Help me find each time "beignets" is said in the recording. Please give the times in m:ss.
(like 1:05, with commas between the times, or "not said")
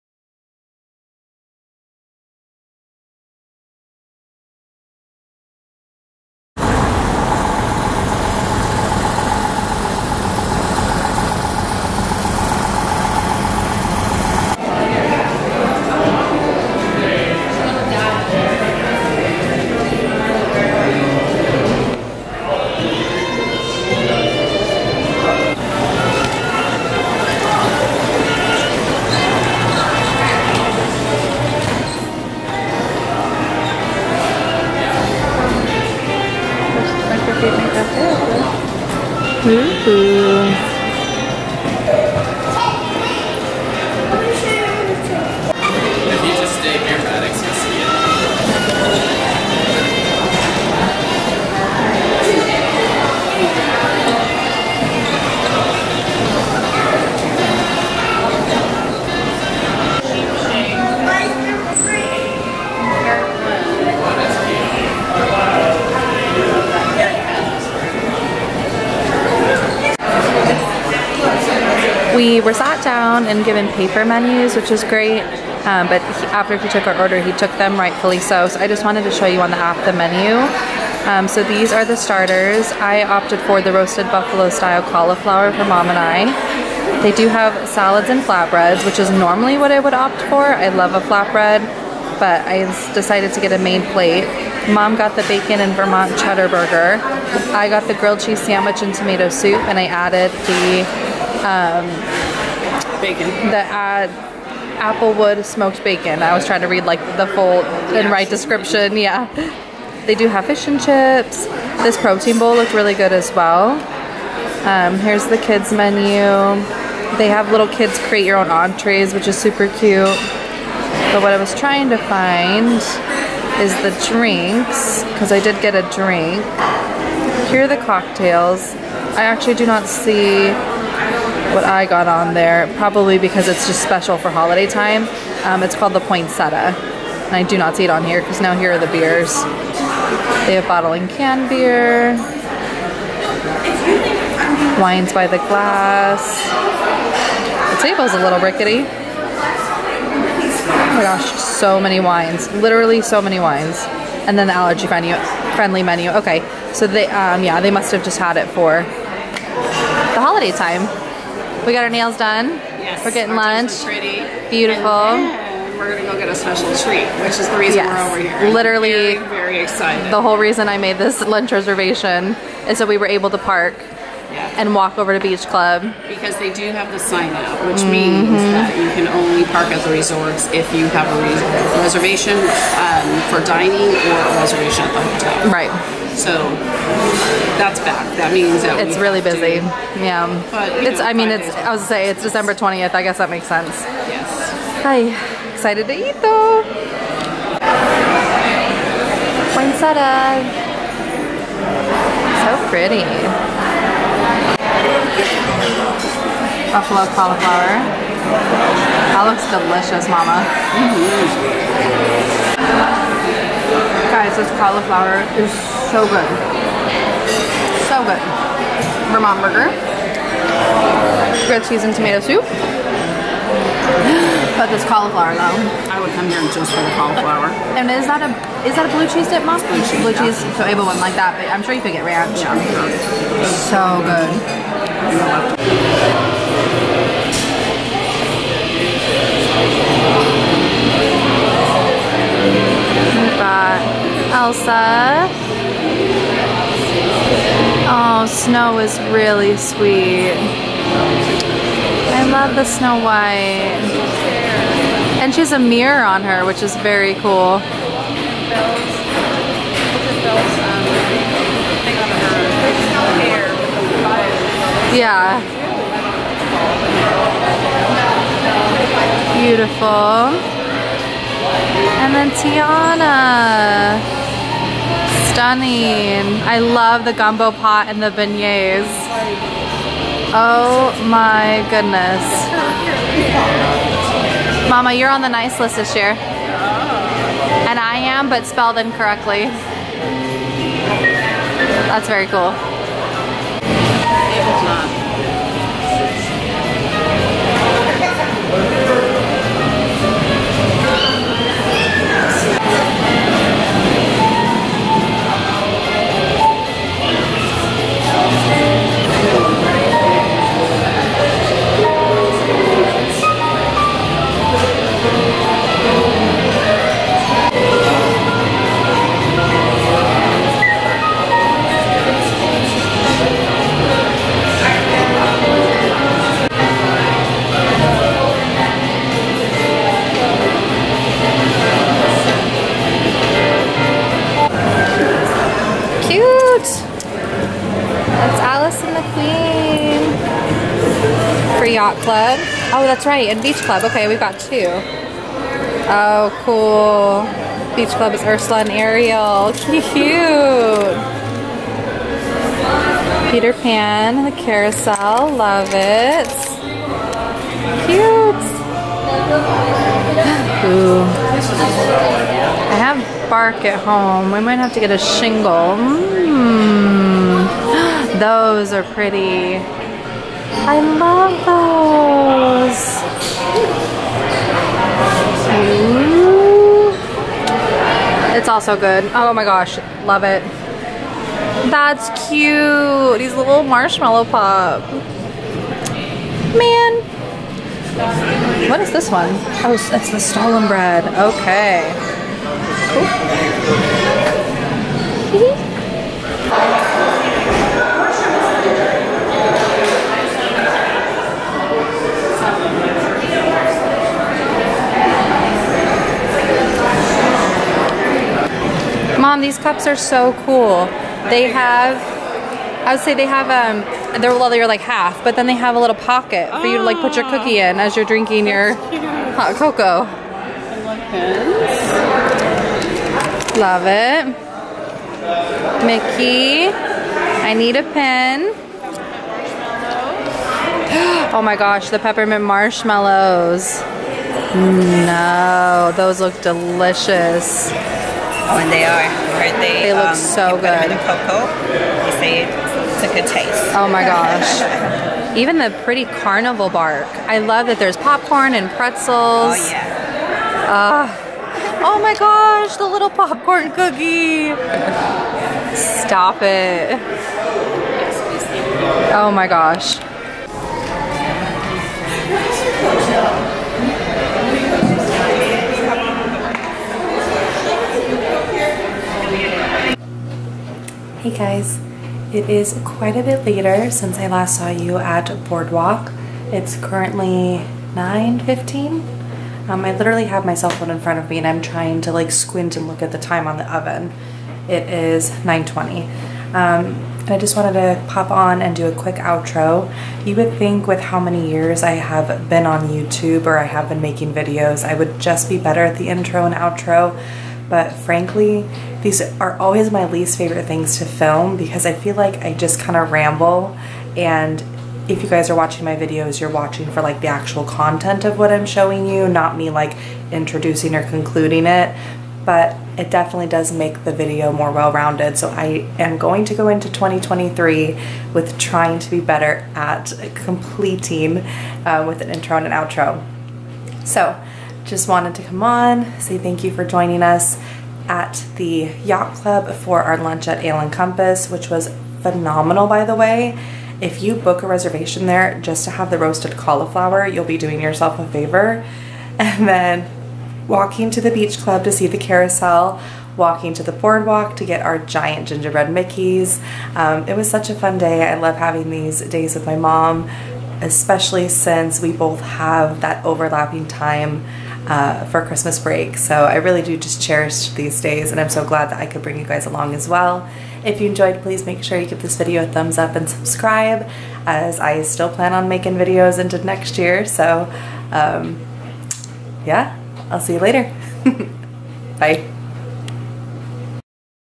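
4:38.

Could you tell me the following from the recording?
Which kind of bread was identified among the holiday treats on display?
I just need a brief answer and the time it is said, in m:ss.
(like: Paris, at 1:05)
stollen bread, at 6:30.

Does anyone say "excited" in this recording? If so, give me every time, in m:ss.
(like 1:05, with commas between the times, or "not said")
2:49, 3:15.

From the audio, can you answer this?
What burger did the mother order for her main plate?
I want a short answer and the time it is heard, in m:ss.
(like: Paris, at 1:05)
bacon and Vermont cheddar burger, at 1:35.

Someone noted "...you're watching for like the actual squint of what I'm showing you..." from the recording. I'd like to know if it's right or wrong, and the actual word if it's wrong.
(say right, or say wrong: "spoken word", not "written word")
wrong: "content", not "squint".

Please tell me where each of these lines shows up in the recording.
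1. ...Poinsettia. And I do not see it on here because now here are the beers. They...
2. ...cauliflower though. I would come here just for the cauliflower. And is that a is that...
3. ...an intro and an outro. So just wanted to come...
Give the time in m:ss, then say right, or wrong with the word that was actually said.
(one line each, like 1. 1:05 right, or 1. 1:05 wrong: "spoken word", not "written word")
1. 2:15 right
2. 3:44 right
3. 8:42 right.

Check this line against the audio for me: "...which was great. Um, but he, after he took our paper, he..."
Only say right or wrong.
wrong.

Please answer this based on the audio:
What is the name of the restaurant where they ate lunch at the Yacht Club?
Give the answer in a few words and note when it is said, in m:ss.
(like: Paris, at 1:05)
Ale and Compass, at 8:50.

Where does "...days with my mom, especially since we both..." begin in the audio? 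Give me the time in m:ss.
9:09.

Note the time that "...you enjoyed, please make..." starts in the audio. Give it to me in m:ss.
9:20.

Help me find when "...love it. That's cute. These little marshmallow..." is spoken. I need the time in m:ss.
6:20.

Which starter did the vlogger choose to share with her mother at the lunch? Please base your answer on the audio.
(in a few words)
roasted buffalo style cauliflower.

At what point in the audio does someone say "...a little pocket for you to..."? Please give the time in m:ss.
6:55.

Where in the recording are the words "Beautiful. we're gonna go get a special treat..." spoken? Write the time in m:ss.
2:44.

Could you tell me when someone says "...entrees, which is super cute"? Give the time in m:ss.
1:58.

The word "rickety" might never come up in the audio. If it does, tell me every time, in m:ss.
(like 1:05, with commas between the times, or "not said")
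2:28.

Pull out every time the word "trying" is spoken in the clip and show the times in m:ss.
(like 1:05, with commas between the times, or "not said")
1:46, 2:01, 8:01, 8:38.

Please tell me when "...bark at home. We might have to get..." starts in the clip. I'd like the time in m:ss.
6:03.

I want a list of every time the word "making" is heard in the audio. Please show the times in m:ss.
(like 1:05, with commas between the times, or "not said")
8:14, 9:25.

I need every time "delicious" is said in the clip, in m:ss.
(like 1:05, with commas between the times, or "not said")
3:29, 7:16.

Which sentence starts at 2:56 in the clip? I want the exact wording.
Because they do have the sign out, which mm -hmm.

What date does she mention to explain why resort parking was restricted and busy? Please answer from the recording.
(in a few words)
December 20.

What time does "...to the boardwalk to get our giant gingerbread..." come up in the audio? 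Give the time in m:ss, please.
9:03.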